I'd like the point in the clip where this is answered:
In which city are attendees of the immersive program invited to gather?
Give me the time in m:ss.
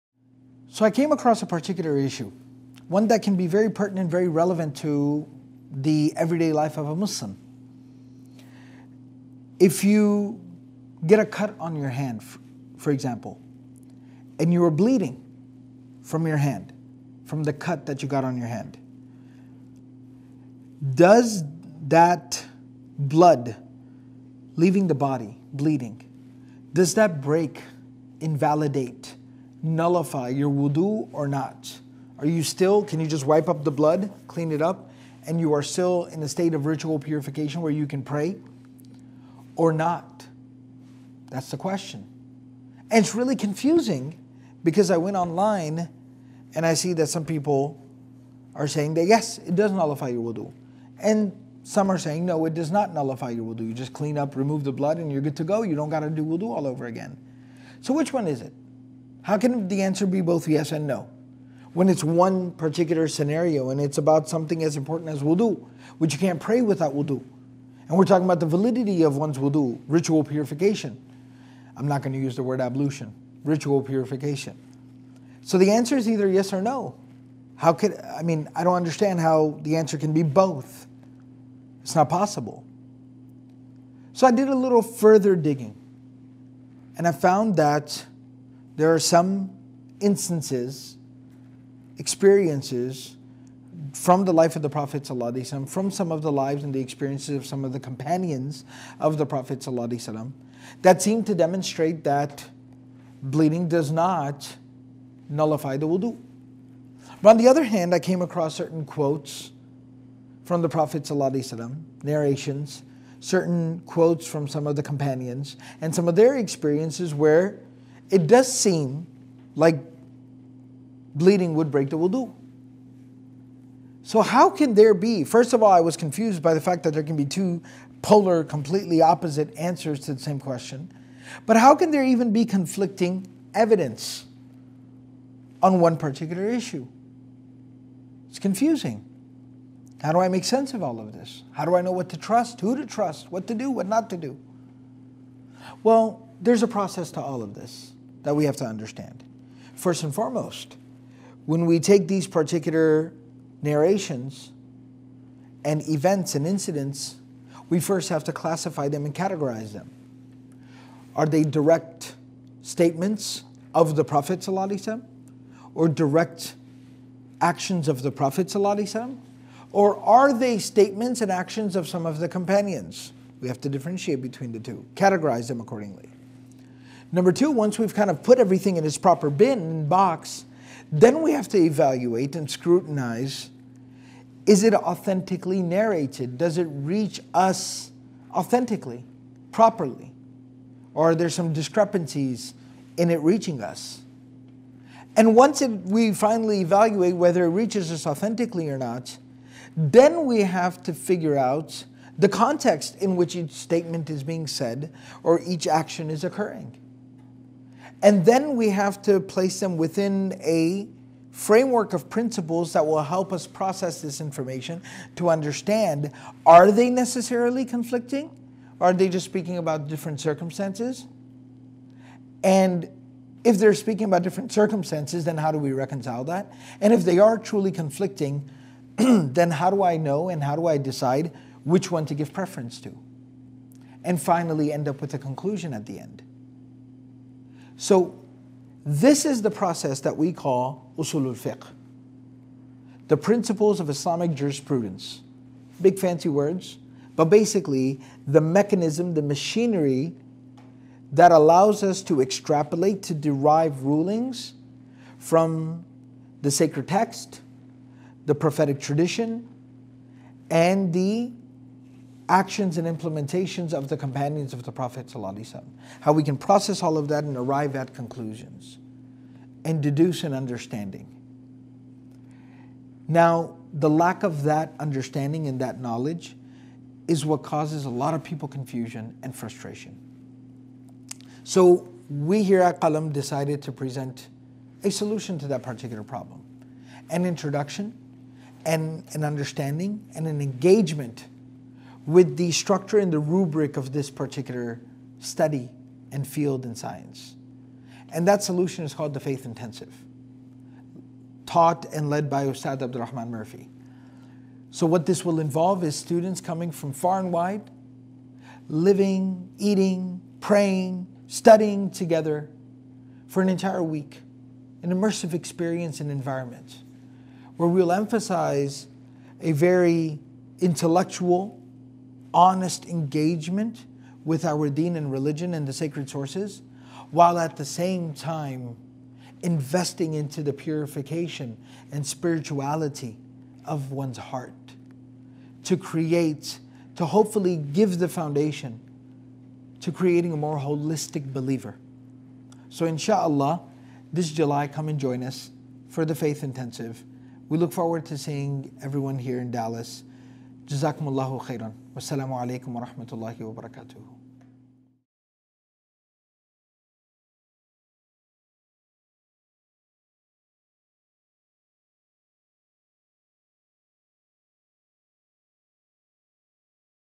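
5:49.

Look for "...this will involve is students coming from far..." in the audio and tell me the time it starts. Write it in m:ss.
5:05.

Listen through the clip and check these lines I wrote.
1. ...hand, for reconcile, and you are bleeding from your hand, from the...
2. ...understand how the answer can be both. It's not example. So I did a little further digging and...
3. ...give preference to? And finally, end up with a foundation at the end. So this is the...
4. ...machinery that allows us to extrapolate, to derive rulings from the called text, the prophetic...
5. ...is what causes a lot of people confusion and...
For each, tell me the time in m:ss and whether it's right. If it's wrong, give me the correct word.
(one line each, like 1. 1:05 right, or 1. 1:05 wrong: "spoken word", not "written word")
1. 0:11 wrong: "example", not "reconcile"
2. 1:18 wrong: "possible", not "example"
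3. 3:52 wrong: "conclusion", not "foundation"
4. 4:09 wrong: "sacred", not "called"
5. 4:37 right.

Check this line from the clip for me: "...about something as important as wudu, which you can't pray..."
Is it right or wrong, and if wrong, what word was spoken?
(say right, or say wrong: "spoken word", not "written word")
right.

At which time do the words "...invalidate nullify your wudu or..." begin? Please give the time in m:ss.
0:28.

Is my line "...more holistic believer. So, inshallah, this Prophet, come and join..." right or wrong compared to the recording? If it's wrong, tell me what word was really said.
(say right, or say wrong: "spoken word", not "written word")
wrong: "July", not "Prophet".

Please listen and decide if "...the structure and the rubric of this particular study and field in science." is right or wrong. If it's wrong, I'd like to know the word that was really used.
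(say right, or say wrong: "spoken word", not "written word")
right.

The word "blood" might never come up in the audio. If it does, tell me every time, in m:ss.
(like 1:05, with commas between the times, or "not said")
0:22, 0:33, 0:54.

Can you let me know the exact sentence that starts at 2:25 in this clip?
Well, there's a process to all of this that we have to understand.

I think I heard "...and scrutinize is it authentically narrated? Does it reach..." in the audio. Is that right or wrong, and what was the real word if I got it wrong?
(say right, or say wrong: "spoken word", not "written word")
right.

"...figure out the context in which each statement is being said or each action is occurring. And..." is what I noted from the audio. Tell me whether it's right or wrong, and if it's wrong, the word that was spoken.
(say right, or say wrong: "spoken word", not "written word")
right.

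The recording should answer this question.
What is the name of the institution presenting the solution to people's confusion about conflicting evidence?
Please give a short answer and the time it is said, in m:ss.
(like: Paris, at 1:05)
Qalam, at 4:42.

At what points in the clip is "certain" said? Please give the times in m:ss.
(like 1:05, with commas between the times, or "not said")
1:48, 1:53.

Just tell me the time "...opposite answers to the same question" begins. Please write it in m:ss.
2:09.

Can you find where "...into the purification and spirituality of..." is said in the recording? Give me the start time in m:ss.
5:30.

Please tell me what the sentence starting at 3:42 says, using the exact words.
And if they're speaking about different circumstances, then how do we reconcile that?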